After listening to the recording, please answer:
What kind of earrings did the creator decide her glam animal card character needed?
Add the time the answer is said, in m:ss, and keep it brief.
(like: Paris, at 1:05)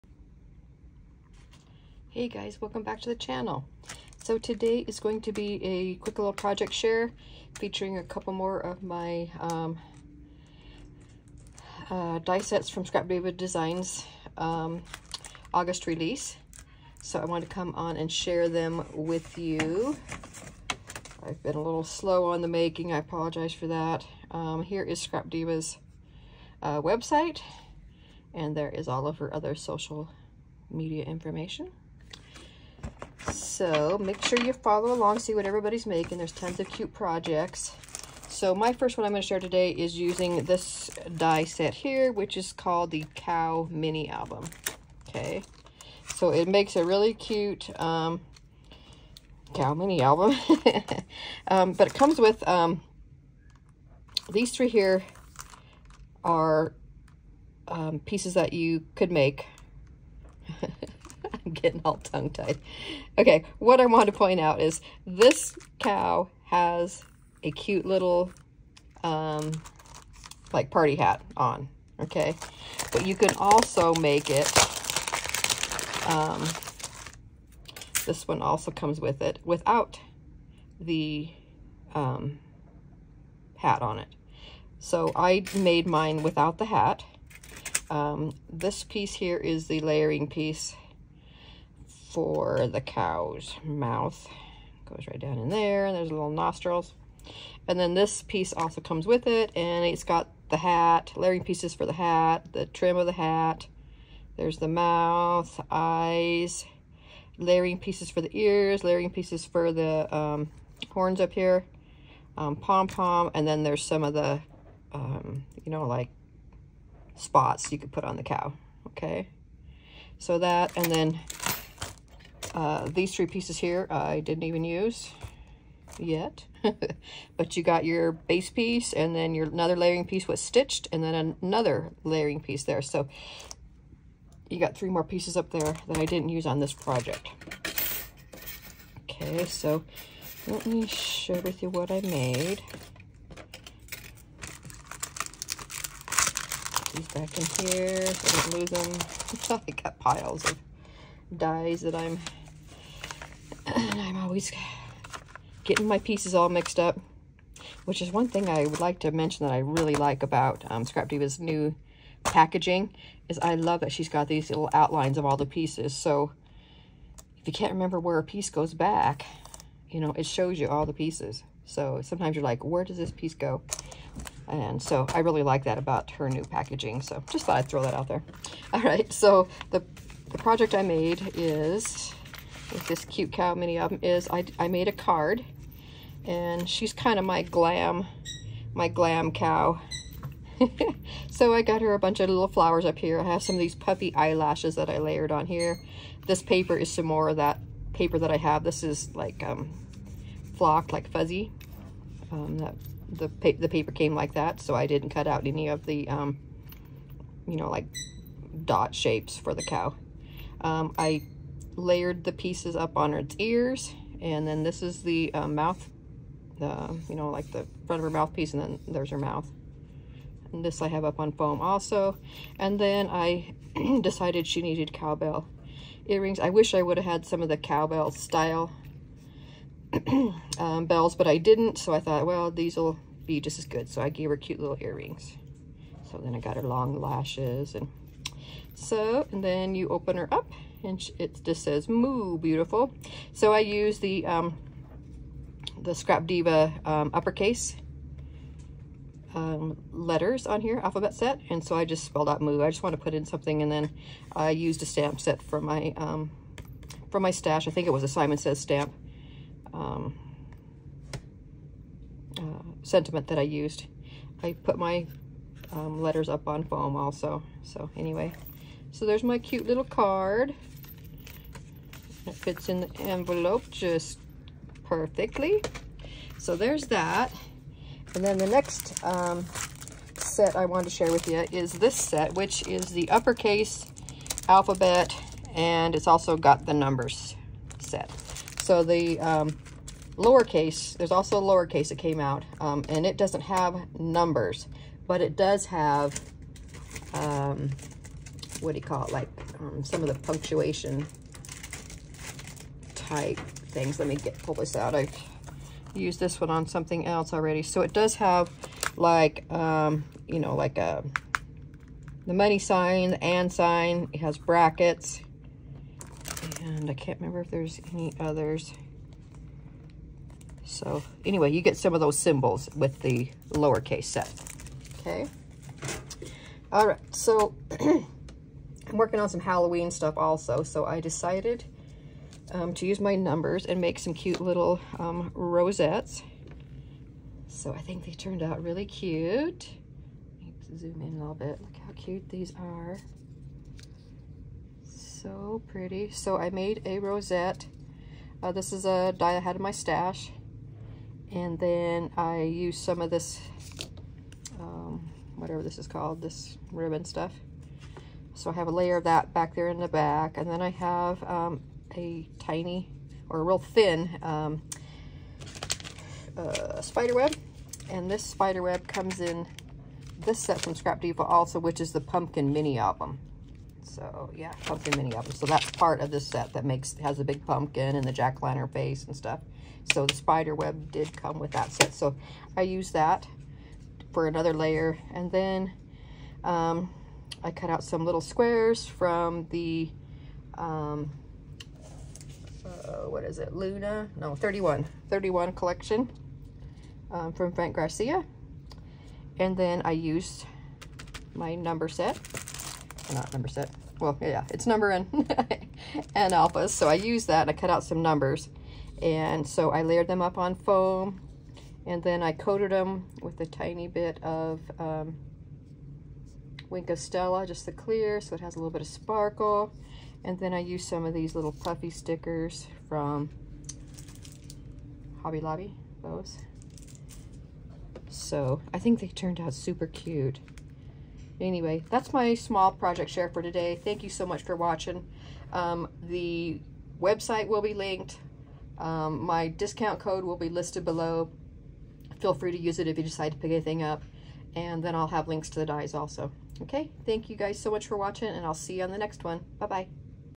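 cowbell earrings, at 3:44.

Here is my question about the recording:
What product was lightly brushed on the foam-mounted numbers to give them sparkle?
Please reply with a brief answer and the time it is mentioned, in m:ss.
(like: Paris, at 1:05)
Wink of Stella, at 6:56.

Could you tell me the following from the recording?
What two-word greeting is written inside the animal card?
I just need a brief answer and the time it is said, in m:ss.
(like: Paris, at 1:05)
moo beautiful, at 4:01.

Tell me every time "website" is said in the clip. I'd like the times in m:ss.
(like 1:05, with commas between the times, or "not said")
0:26, 7:17.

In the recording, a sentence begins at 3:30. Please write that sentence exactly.
Um, I layered the pieces up on its ears.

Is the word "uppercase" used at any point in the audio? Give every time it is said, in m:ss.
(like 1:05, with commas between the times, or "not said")
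4:07, 4:43.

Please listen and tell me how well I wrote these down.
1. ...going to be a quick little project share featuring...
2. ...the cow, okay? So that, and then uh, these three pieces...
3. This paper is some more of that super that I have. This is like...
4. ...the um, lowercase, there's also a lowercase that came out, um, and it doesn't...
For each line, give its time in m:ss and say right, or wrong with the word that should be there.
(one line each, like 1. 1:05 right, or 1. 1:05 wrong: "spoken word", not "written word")
1. 0:04 right
2. 1:58 right
3. 3:16 wrong: "paper", not "super"
4. 4:48 right.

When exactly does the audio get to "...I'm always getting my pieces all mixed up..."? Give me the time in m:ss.
2:34.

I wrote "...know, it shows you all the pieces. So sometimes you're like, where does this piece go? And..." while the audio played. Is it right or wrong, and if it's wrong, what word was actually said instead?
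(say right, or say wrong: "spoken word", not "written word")
right.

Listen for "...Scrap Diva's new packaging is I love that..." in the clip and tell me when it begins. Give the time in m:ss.
2:40.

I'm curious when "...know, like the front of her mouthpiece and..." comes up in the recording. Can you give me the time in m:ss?
3:37.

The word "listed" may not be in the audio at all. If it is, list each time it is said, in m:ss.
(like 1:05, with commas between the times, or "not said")
7:20.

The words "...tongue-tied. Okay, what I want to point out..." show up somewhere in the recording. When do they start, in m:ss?
1:01.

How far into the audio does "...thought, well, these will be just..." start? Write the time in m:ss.
3:51.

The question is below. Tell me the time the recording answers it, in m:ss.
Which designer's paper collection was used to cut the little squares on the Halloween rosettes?
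6:37.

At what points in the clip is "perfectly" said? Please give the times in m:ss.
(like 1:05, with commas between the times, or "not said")
4:34.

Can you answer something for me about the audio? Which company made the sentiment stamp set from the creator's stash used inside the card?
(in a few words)
Simon Says Stamp.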